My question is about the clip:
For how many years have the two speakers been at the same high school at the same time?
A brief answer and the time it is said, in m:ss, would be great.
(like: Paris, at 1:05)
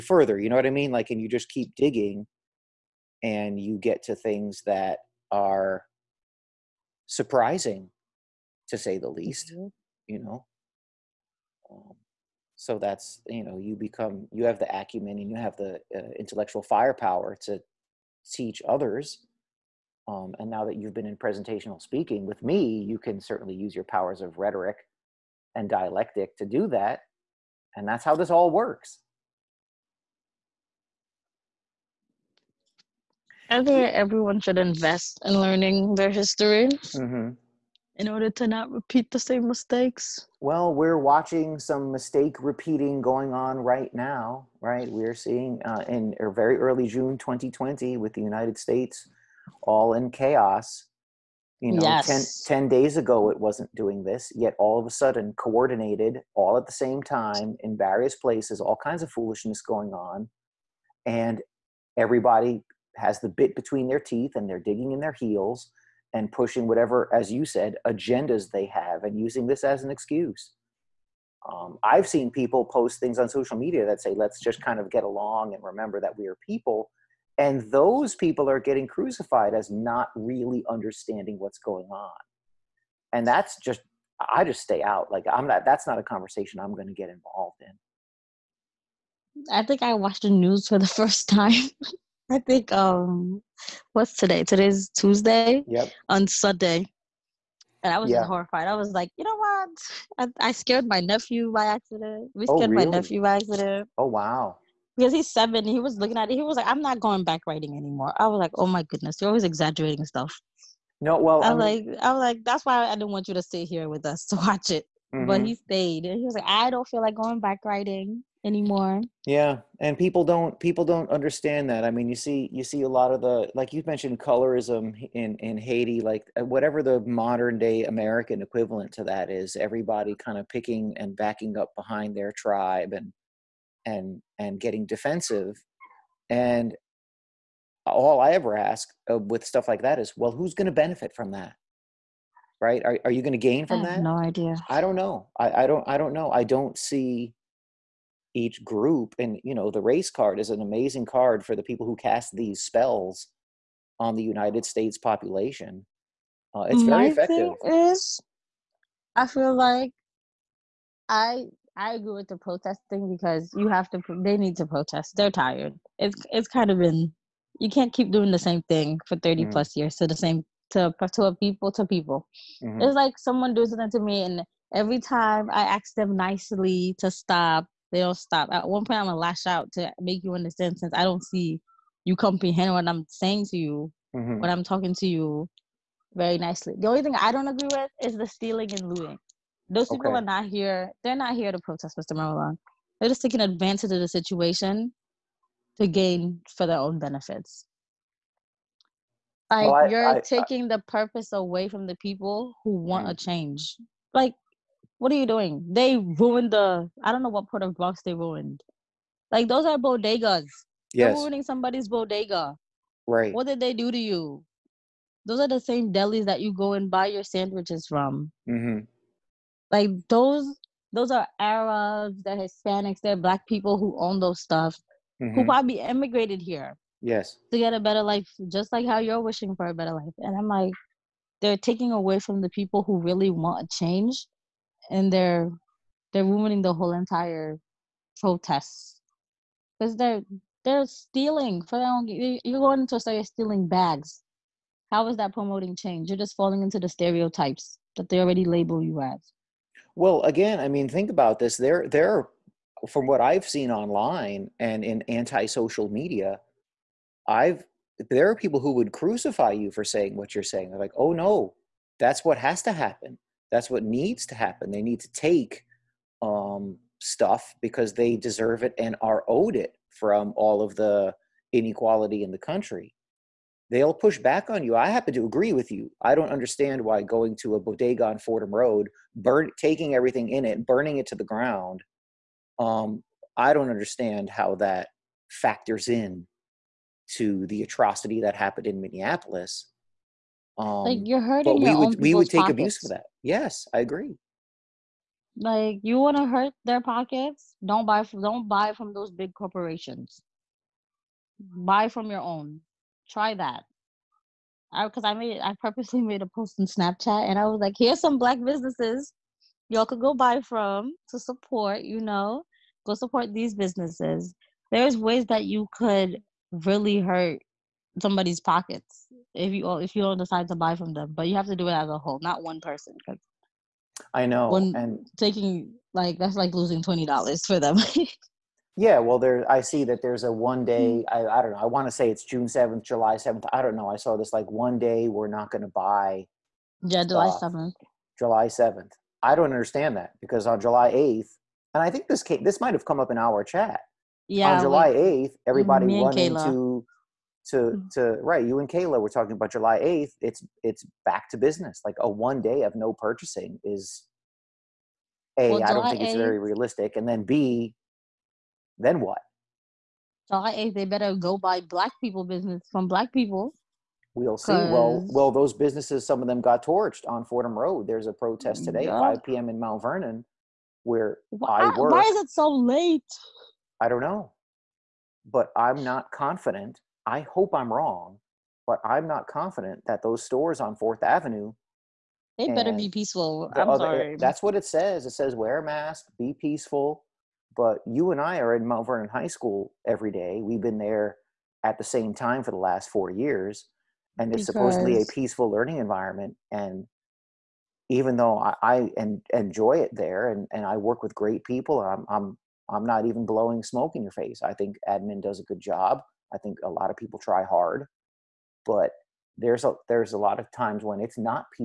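4, at 6:32.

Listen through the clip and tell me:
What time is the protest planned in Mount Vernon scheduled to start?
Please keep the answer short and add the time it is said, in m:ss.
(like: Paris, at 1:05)
5 p.m., at 6:08.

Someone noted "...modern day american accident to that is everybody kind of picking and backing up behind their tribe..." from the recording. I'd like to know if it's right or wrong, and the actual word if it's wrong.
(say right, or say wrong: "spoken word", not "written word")
wrong: "equivalent", not "accident".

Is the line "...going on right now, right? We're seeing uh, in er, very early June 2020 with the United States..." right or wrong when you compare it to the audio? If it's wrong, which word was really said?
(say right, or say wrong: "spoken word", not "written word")
right.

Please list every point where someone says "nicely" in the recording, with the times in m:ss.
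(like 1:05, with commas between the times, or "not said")
2:56, 3:06.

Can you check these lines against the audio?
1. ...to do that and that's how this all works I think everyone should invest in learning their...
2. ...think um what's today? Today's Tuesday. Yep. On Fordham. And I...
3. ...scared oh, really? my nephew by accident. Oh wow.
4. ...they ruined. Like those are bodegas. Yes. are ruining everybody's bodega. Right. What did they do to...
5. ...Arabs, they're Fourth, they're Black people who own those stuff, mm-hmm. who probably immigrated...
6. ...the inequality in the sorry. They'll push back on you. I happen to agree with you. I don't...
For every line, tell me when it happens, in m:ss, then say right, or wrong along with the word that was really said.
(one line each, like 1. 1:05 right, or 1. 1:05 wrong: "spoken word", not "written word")
1. 0:26 right
2. 1:32 wrong: "Sunday", not "Fordham"
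3. 1:42 right
4. 3:28 wrong: "somebody", not "everybody"
5. 3:41 wrong: "Hispanics", not "Fourth"
6. 4:30 wrong: "country", not "sorry".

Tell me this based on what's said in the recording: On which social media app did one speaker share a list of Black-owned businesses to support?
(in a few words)
Snapchat.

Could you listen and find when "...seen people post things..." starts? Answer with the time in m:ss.
1:12.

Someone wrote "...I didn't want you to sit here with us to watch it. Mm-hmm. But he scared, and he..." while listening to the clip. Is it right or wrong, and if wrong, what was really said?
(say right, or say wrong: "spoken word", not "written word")
wrong: "stayed", not "scared".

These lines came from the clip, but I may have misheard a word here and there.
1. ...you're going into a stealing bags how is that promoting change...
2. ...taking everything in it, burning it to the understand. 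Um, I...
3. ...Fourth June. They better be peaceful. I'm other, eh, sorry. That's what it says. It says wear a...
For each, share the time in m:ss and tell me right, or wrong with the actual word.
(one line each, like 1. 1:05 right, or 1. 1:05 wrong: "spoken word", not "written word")
1. 4:02 right
2. 4:39 wrong: "ground", not "understand"
3. 6:20 wrong: "Avenue", not "June".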